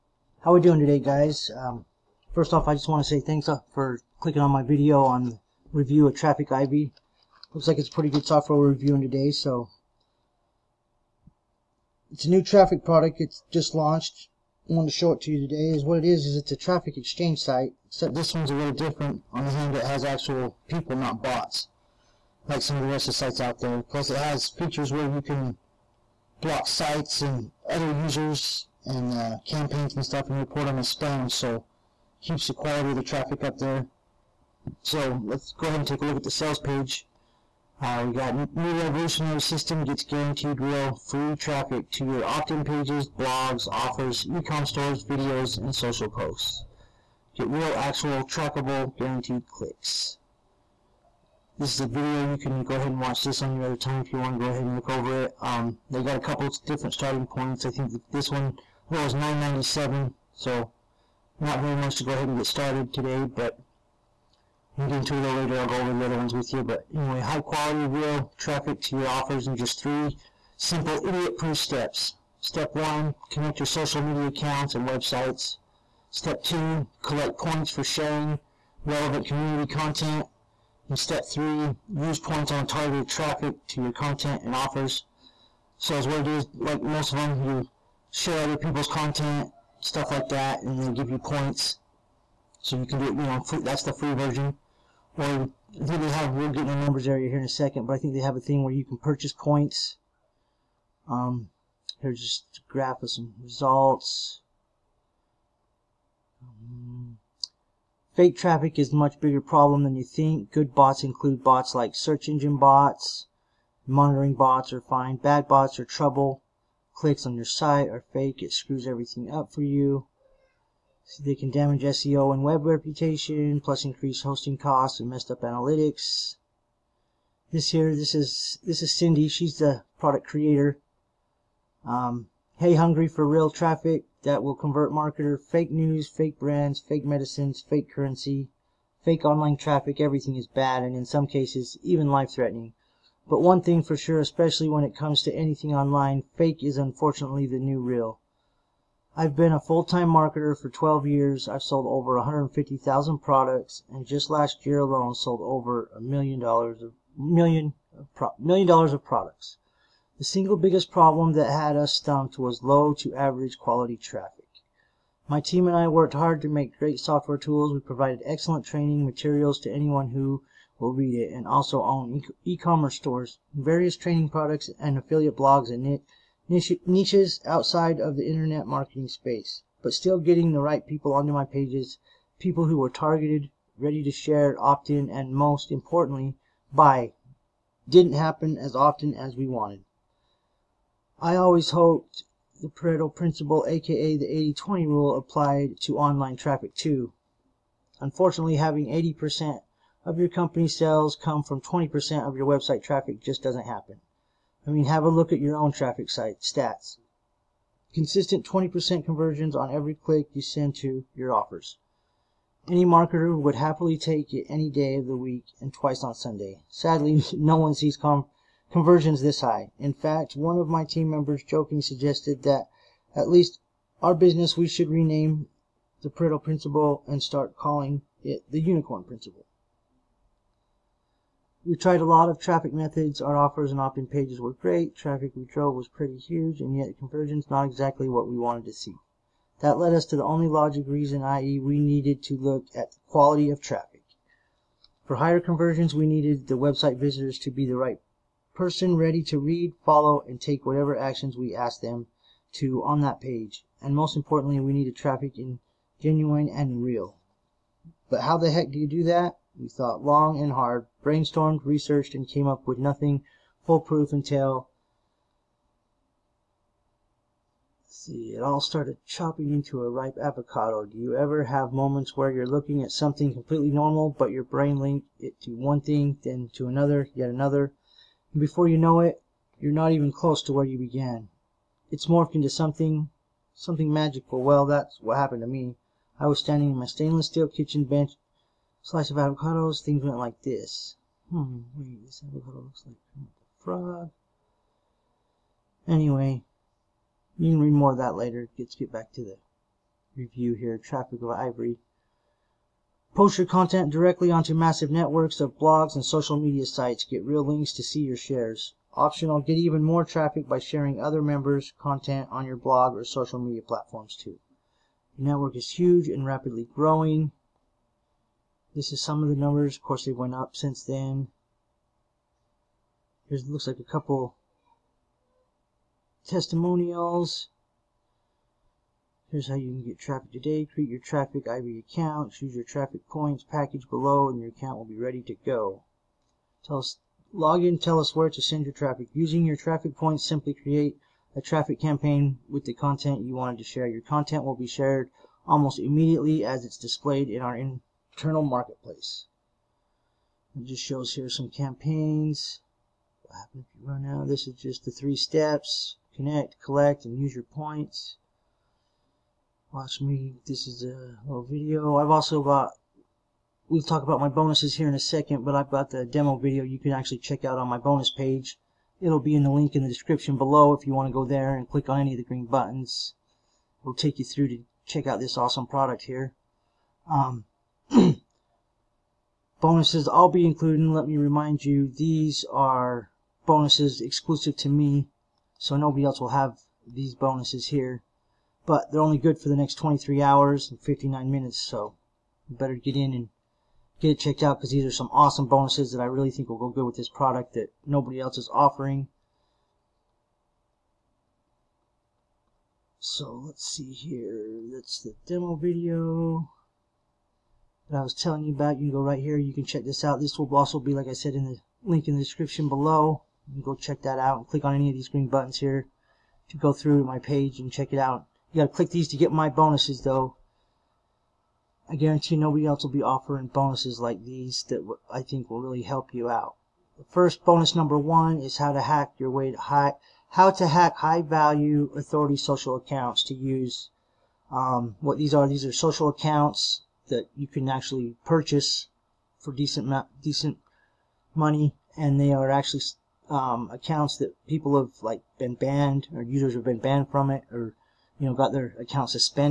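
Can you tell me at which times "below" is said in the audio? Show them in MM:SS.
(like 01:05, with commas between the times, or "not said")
05:33, 06:10, 06:52.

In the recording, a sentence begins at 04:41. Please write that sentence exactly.
It's morphed into something, something magical.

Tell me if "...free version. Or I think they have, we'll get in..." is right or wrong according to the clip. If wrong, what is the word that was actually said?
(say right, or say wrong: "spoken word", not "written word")
right.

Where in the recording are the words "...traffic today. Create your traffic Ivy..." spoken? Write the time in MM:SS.
05:29.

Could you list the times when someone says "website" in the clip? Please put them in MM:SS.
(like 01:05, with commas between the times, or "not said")
01:14, 03:22, 04:06.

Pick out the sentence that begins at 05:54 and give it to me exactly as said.
This is just the three steps.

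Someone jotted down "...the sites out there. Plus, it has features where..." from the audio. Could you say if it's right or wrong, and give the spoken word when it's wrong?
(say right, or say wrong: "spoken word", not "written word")
right.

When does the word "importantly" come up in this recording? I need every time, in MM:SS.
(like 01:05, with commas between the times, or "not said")
03:05, 04:14.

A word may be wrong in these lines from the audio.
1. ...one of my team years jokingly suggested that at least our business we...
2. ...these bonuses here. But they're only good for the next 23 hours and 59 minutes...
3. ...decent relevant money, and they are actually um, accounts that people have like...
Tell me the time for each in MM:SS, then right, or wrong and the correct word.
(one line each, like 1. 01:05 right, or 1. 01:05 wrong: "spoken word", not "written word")
1. 03:40 wrong: "members", not "years"
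2. 06:26 right
3. 07:19 wrong: "decent", not "relevant".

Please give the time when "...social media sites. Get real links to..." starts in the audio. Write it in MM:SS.
05:06.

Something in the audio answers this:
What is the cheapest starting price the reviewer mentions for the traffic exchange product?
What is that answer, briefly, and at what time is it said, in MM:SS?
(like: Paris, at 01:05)
$9.97, at 00:59.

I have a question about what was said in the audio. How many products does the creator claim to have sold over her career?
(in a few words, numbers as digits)
150,000.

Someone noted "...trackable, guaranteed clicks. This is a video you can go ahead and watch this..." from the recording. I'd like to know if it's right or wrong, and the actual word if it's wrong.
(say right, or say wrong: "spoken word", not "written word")
right.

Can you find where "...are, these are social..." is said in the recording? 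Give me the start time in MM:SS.
07:15.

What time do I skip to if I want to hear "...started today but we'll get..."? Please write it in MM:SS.
01:02.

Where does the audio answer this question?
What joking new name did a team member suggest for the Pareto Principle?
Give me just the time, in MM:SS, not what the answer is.
03:48.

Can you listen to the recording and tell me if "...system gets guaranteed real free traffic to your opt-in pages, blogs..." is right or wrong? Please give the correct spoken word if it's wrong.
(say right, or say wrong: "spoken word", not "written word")
right.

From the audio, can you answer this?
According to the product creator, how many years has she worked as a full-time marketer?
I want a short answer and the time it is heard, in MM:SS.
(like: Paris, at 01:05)
12, at 02:30.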